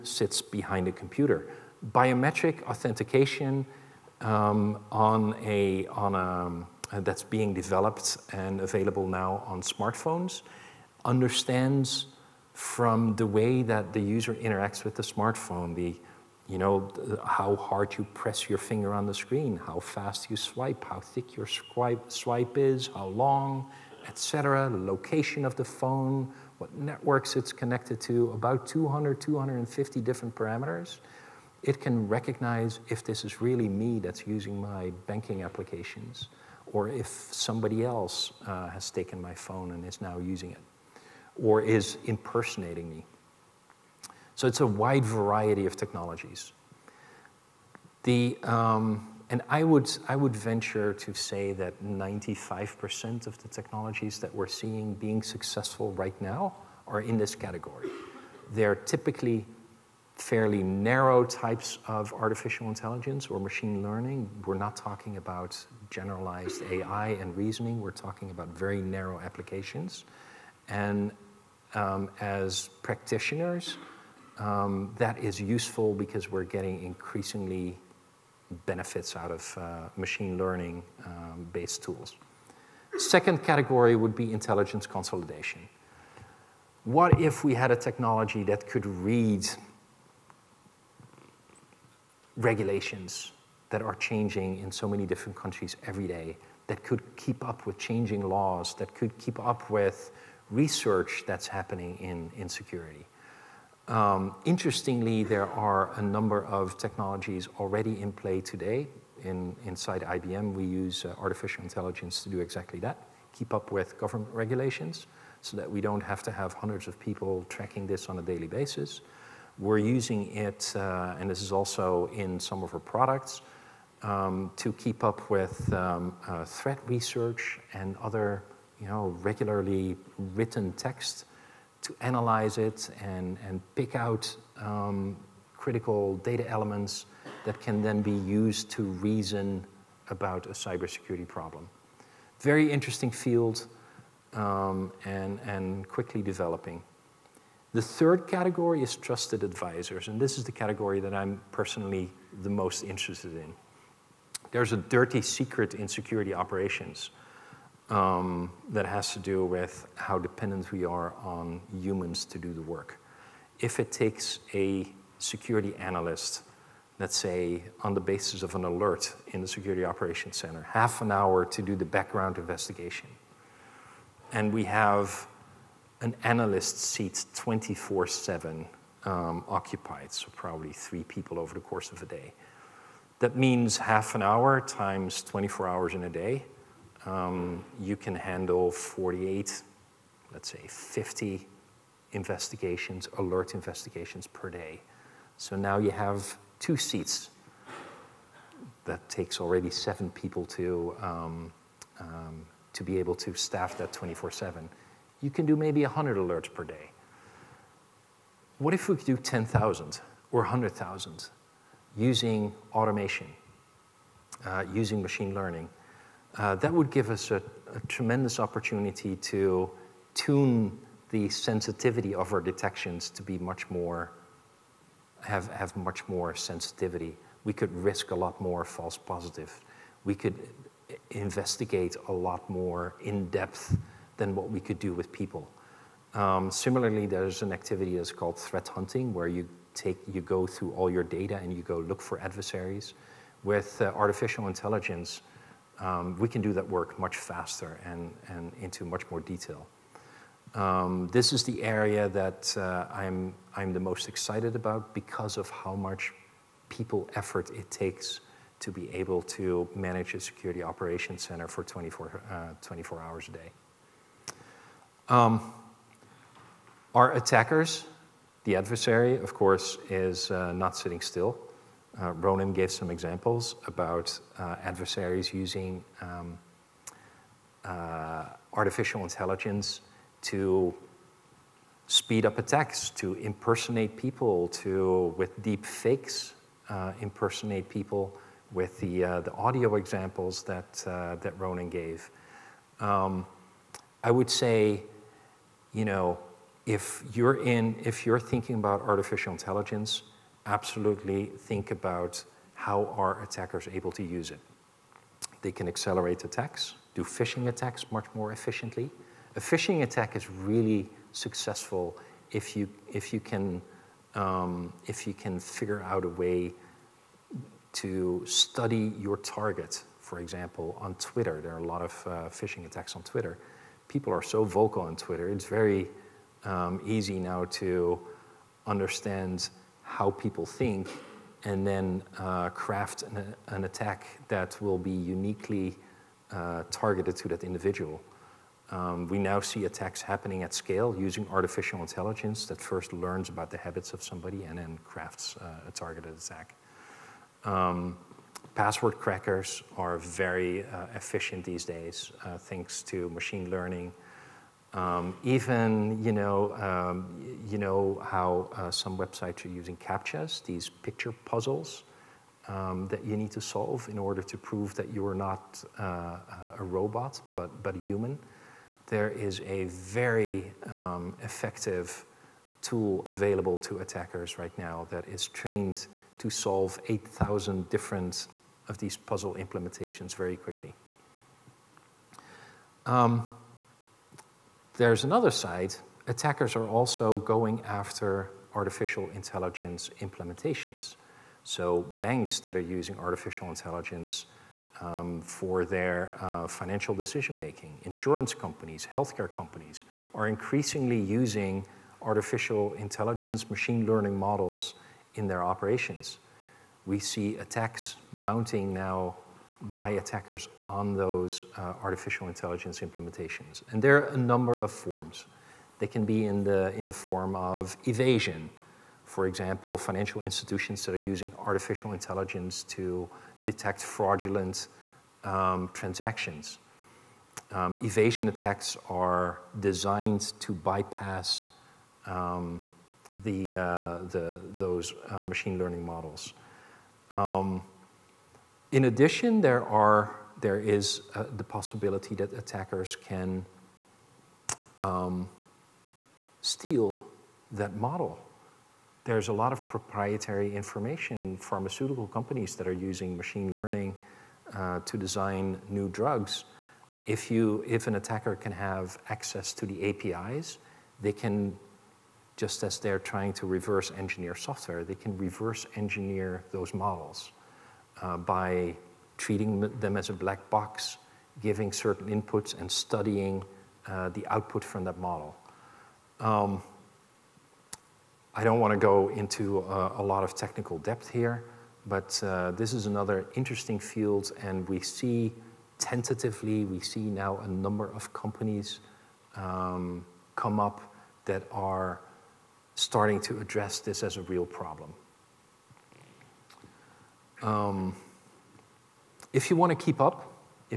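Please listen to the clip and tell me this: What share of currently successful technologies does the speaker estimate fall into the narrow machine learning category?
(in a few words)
95%.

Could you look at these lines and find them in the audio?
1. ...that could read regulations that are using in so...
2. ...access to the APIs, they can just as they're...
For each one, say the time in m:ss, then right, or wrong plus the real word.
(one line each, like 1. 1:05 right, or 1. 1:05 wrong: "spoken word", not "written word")
1. 1:28 wrong: "changing", not "using"
2. 7:39 right.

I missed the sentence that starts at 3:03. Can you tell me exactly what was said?
That means half an hour times 24 hours in a day.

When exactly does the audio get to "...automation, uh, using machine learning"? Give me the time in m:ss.
3:32.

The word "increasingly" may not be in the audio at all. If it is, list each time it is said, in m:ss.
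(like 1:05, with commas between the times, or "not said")
1:16, 6:40.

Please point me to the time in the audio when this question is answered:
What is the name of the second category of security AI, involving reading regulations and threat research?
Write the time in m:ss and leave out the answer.
1:24.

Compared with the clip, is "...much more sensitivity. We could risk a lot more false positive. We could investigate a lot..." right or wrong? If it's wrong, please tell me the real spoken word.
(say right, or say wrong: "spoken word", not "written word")
right.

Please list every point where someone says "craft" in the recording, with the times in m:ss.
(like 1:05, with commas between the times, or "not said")
5:32, 5:44.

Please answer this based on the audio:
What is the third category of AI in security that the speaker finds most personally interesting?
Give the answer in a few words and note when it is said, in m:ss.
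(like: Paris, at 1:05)
trusted advisors, at 2:28.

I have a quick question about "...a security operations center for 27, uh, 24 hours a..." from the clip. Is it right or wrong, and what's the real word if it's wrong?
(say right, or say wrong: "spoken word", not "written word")
wrong: "24", not "27".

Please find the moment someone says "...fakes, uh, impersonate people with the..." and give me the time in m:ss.
4:45.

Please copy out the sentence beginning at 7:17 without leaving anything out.
Um, in addition, there, are, there is uh, the possibility that attackers can um, steal that model.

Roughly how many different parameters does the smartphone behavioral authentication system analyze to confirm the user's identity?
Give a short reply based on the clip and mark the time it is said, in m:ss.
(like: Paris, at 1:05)
200-250, at 0:28.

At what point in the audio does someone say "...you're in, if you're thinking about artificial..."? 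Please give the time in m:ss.
4:57.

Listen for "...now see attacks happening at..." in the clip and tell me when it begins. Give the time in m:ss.
5:39.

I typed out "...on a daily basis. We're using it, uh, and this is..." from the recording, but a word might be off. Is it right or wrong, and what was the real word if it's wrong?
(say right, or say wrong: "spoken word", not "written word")
right.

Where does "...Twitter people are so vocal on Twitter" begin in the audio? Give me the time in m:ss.
5:23.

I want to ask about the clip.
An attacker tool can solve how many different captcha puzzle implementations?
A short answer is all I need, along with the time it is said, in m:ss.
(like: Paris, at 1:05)
8,000, at 6:16.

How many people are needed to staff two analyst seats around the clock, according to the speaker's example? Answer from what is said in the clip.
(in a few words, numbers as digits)
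7.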